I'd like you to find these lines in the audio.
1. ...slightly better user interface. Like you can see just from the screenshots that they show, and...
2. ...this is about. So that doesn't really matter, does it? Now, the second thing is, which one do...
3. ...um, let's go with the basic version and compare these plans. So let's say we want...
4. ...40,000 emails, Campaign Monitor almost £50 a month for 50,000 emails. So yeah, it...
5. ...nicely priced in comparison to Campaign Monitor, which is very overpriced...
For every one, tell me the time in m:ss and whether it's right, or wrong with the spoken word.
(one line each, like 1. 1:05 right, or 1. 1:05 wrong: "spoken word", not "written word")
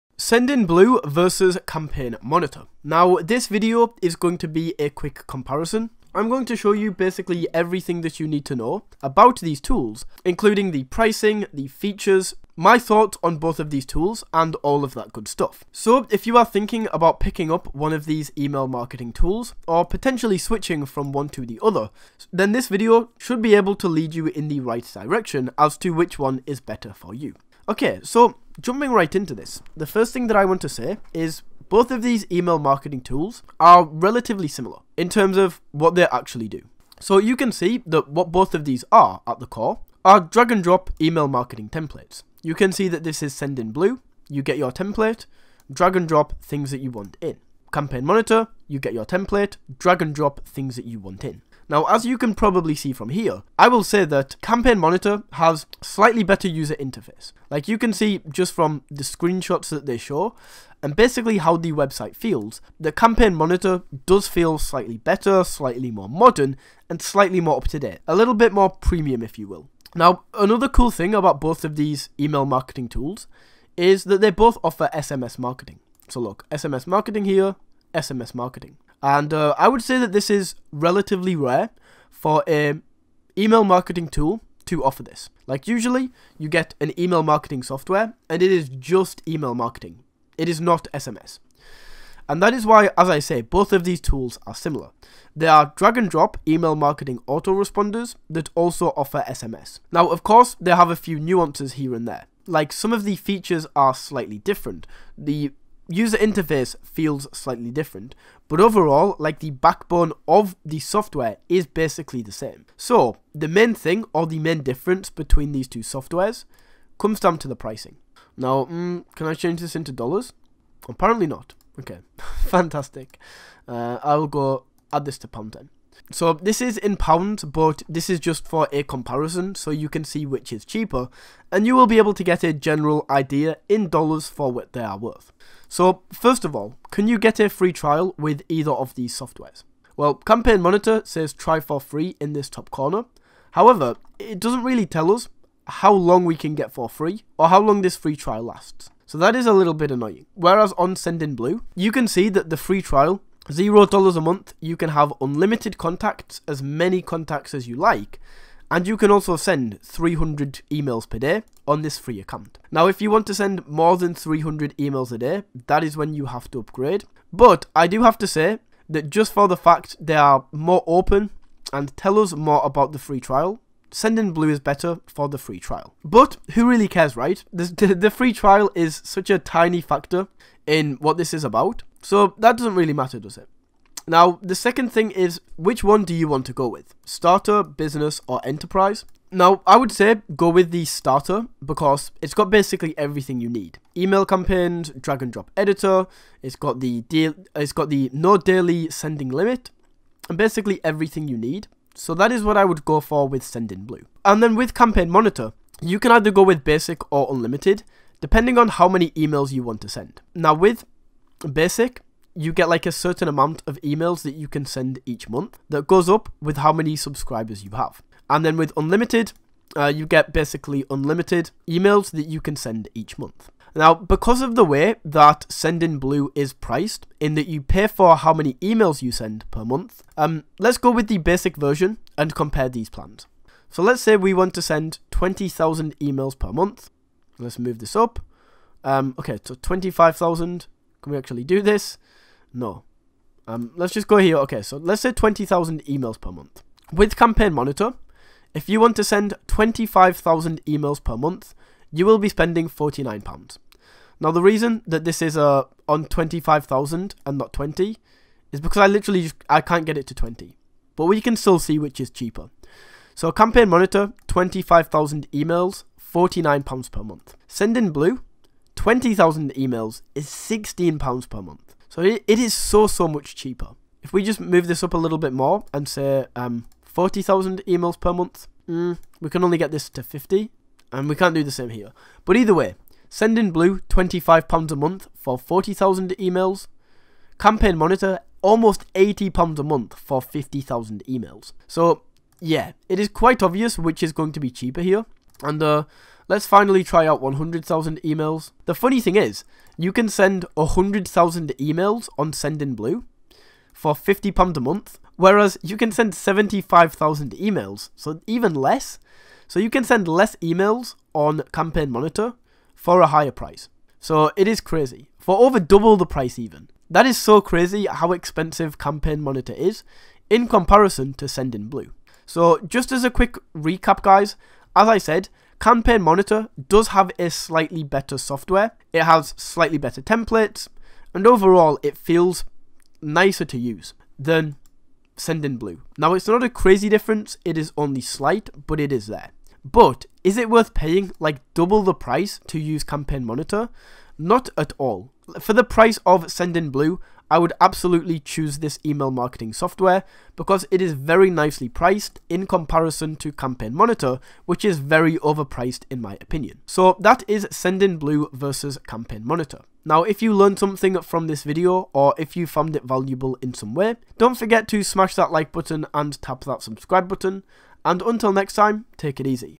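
1. 0:55 right
2. 3:01 right
3. 3:50 right
4. 4:45 wrong: "80", not "50"
5. 5:51 right.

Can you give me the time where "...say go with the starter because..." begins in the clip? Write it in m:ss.
3:09.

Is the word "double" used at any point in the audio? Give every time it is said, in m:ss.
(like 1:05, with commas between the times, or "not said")
5:15, 5:41.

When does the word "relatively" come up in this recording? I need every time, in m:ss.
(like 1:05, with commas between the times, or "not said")
0:33, 1:20.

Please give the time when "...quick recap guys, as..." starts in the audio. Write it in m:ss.
5:23.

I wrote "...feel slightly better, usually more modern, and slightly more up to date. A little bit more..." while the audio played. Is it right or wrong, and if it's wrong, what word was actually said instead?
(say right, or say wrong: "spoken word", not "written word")
wrong: "slightly", not "usually".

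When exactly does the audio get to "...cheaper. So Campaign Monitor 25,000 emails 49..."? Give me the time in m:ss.
4:22.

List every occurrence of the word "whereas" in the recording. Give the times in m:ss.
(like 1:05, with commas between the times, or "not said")
2:30, 5:05.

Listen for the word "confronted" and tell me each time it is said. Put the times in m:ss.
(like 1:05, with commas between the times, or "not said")
not said.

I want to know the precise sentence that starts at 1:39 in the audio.
Now, of course, they have a few nuances here and there.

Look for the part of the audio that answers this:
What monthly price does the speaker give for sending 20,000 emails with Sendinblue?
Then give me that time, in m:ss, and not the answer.
4:30.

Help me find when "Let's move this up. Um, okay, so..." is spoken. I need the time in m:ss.
3:57.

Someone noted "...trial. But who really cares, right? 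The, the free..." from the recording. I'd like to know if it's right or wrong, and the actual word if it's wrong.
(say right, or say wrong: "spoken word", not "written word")
right.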